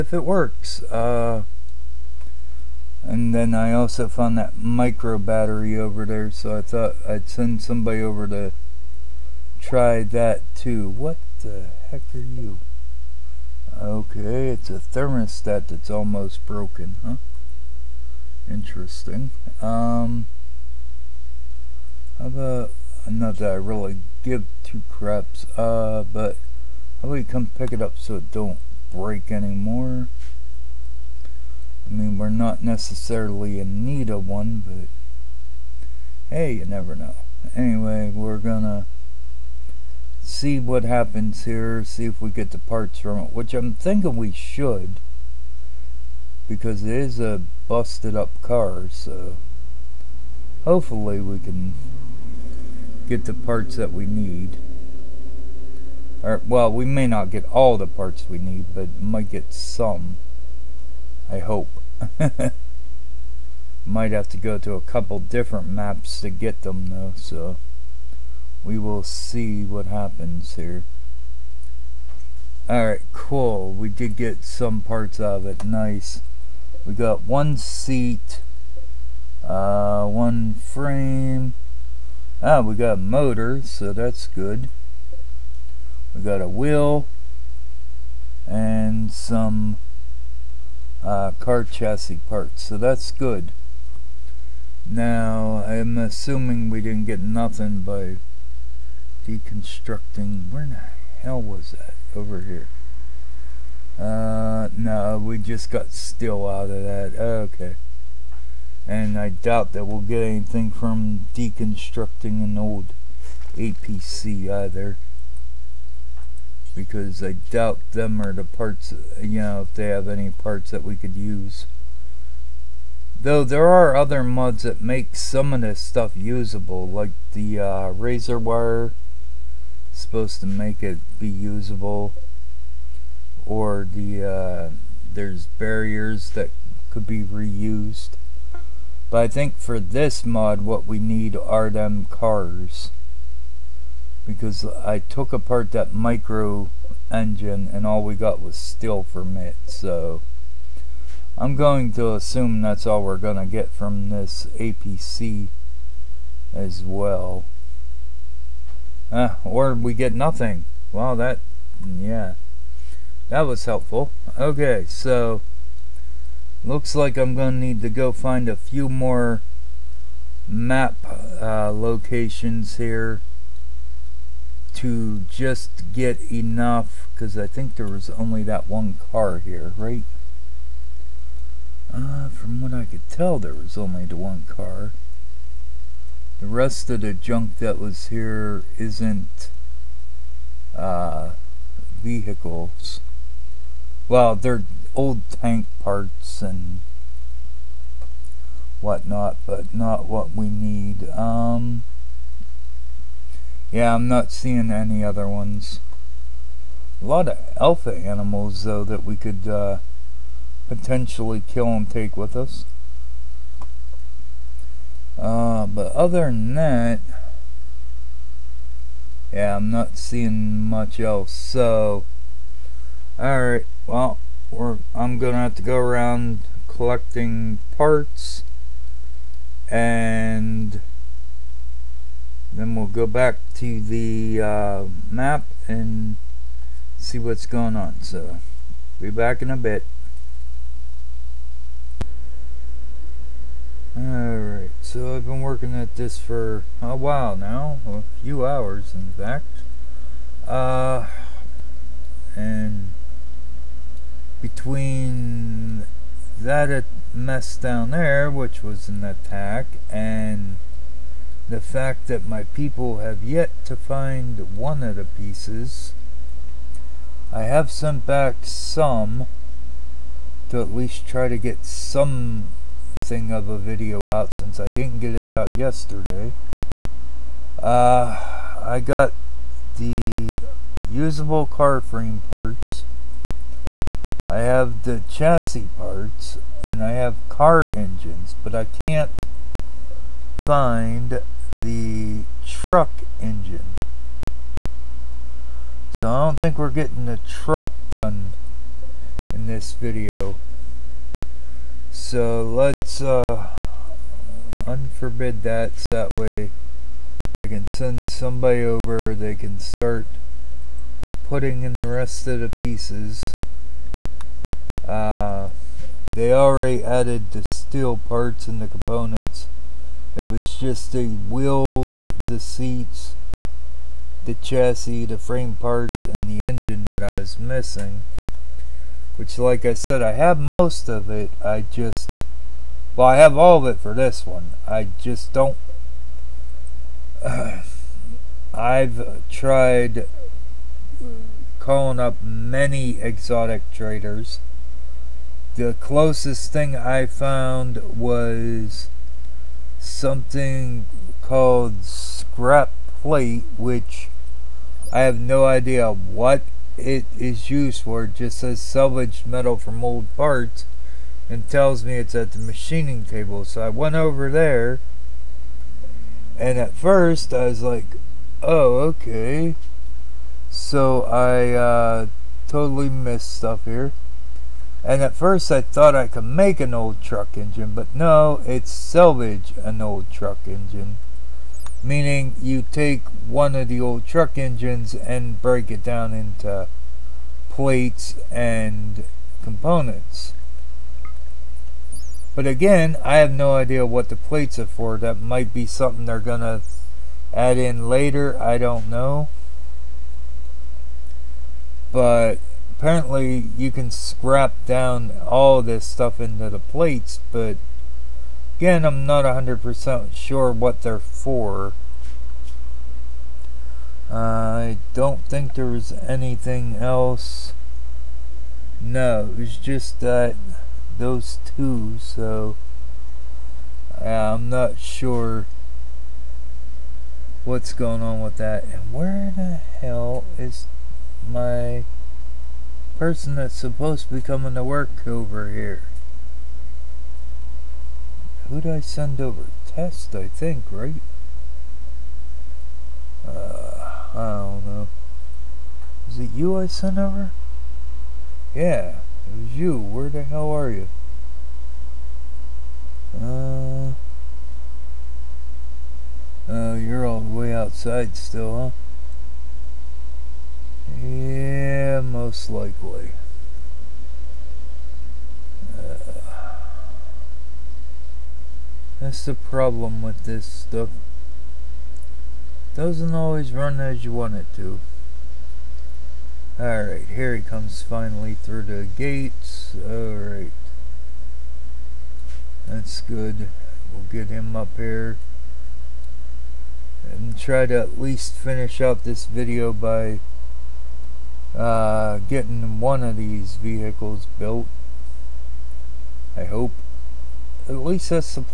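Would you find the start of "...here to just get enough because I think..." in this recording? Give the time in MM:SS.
02:52.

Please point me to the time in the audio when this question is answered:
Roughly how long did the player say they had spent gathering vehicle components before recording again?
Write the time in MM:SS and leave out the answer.
04:07.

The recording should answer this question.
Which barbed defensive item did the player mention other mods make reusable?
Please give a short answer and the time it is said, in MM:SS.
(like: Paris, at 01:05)
Razor wire, at 02:07.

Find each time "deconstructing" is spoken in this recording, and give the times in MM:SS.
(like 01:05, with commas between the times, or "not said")
01:39, 01:51.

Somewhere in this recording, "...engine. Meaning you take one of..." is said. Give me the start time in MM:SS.
06:20.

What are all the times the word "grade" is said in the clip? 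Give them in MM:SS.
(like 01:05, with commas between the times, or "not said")
not said.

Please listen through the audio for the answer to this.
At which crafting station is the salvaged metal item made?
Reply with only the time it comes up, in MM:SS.
06:02.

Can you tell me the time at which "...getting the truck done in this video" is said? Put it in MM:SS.
04:56.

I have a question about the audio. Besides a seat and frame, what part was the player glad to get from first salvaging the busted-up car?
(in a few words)
A motor.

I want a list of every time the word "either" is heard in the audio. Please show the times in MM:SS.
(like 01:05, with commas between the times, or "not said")
01:54.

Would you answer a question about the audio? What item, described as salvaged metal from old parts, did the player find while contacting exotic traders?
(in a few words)
Scrap plate.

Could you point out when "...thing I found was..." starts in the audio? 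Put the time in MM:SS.
05:46.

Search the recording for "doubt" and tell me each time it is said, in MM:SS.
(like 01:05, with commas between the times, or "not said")
01:49, 01:57.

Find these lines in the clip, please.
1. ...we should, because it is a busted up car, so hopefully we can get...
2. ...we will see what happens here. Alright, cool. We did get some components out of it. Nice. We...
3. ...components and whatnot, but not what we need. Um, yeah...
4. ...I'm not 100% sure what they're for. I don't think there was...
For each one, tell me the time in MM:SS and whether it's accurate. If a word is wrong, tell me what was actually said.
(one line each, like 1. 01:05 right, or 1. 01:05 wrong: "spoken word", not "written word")
1. 00:44 right
2. 01:08 wrong: "parts", not "components"
3. 03:15 wrong: "parts", not "components"
4. 06:48 right.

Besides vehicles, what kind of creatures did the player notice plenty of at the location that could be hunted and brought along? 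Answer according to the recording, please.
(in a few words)
Alpha animals.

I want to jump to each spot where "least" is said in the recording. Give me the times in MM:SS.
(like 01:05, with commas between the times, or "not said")
04:30, 08:07, 08:17.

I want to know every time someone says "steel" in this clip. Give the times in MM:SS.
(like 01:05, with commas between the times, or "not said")
01:45, 02:28, 05:17.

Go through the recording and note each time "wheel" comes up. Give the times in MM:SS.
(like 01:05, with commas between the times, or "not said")
01:26, 05:21.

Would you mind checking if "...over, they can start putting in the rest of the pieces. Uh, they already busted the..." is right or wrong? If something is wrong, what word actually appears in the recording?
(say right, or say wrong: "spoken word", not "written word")
wrong: "added", not "busted".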